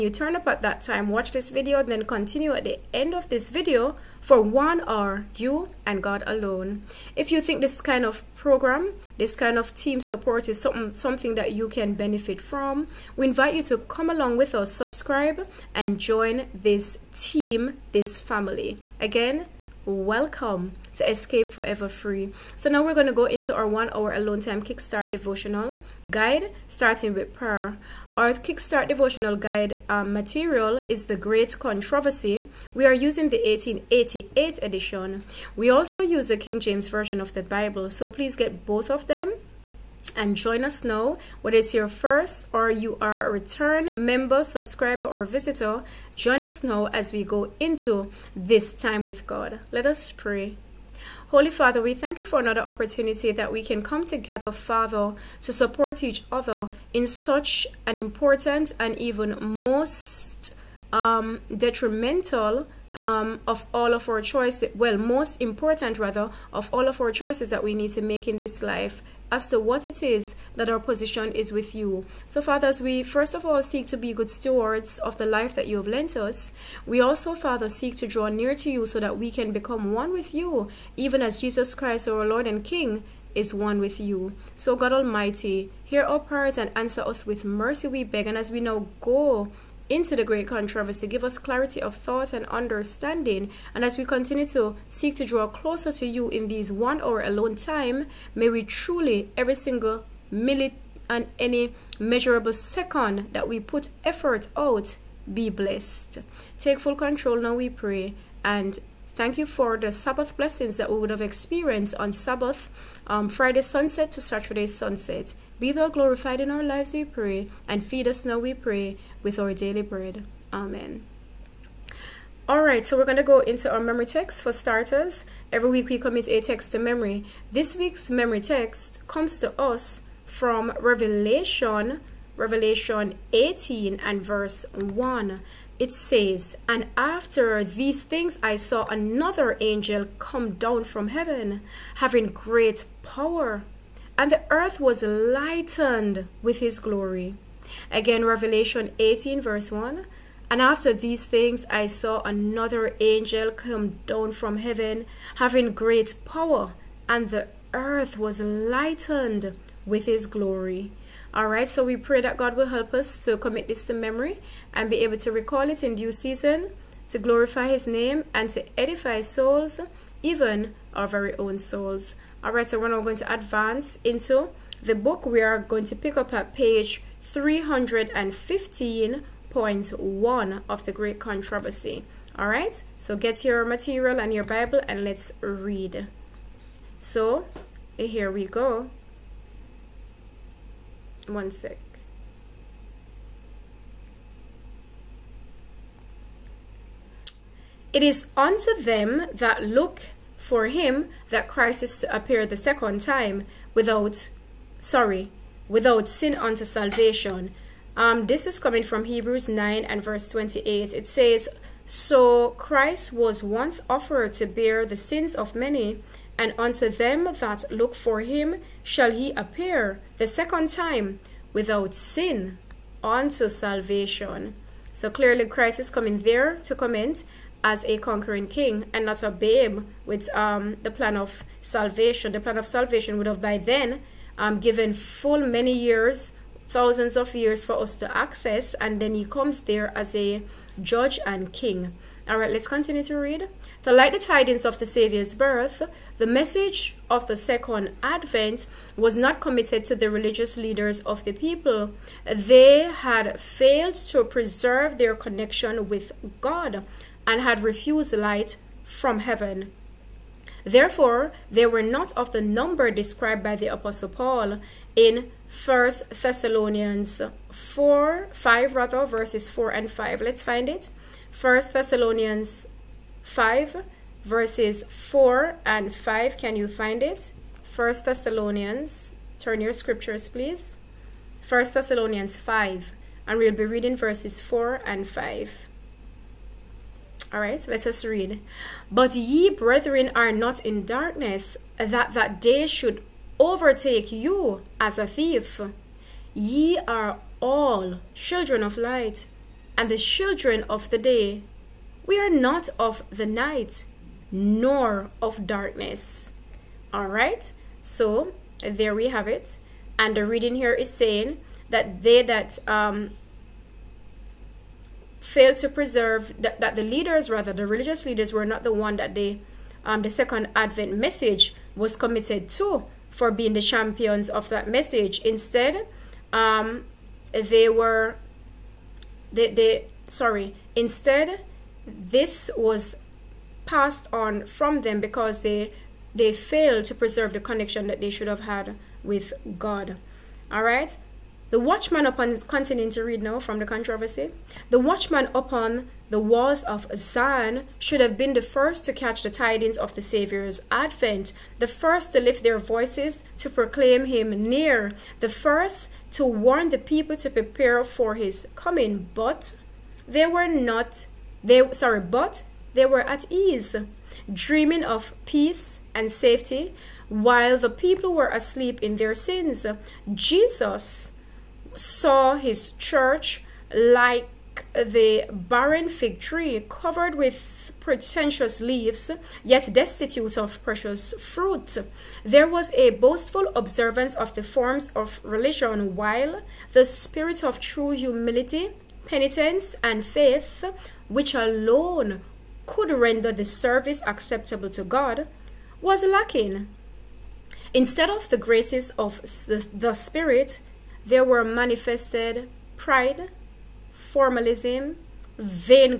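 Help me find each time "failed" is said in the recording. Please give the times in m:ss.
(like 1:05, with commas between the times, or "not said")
4:13, 5:15, 5:36.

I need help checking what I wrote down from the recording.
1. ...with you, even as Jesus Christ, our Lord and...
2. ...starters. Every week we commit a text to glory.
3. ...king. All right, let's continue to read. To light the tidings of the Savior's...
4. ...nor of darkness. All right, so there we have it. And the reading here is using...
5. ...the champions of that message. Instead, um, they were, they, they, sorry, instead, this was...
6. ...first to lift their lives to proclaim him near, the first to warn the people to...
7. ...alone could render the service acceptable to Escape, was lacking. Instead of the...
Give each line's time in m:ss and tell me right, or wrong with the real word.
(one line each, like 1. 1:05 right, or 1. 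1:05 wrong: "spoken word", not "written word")
1. 1:20 right
2. 2:04 wrong: "memory", not "glory"
3. 4:01 right
4. 5:04 wrong: "saying", not "using"
5. 5:23 right
6. 5:51 wrong: "voices", not "lives"
7. 6:31 wrong: "God", not "Escape".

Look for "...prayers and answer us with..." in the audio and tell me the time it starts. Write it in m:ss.
1:26.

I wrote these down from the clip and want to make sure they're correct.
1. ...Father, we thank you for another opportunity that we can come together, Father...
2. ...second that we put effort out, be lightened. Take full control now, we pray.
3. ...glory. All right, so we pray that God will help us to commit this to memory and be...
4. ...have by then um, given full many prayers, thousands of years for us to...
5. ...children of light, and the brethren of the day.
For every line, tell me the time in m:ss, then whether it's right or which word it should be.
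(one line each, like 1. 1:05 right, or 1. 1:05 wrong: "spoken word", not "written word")
1. 0:51 right
2. 1:42 wrong: "blessed", not "lightened"
3. 2:40 right
4. 3:53 wrong: "years", not "prayers"
5. 4:58 wrong: "children", not "brethren".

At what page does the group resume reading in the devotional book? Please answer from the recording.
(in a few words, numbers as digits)
315.1.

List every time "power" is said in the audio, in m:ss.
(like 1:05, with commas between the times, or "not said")
2:23, 2:36.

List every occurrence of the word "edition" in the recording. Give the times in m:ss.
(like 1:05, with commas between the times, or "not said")
0:34.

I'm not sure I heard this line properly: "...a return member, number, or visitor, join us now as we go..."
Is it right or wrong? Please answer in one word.
wrong.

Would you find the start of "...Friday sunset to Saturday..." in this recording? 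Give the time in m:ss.
1:53.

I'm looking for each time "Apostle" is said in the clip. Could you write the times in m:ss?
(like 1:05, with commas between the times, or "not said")
4:23.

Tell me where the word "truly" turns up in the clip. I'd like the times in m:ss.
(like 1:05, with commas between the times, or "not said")
1:38.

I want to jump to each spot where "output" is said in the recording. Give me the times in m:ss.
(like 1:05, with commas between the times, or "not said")
not said.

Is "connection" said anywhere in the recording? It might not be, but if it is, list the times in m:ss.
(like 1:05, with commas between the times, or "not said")
4:15, 5:37.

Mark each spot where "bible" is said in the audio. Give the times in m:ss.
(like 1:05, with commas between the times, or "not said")
0:37, 3:04.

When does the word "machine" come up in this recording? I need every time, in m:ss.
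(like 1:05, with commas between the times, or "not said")
not said.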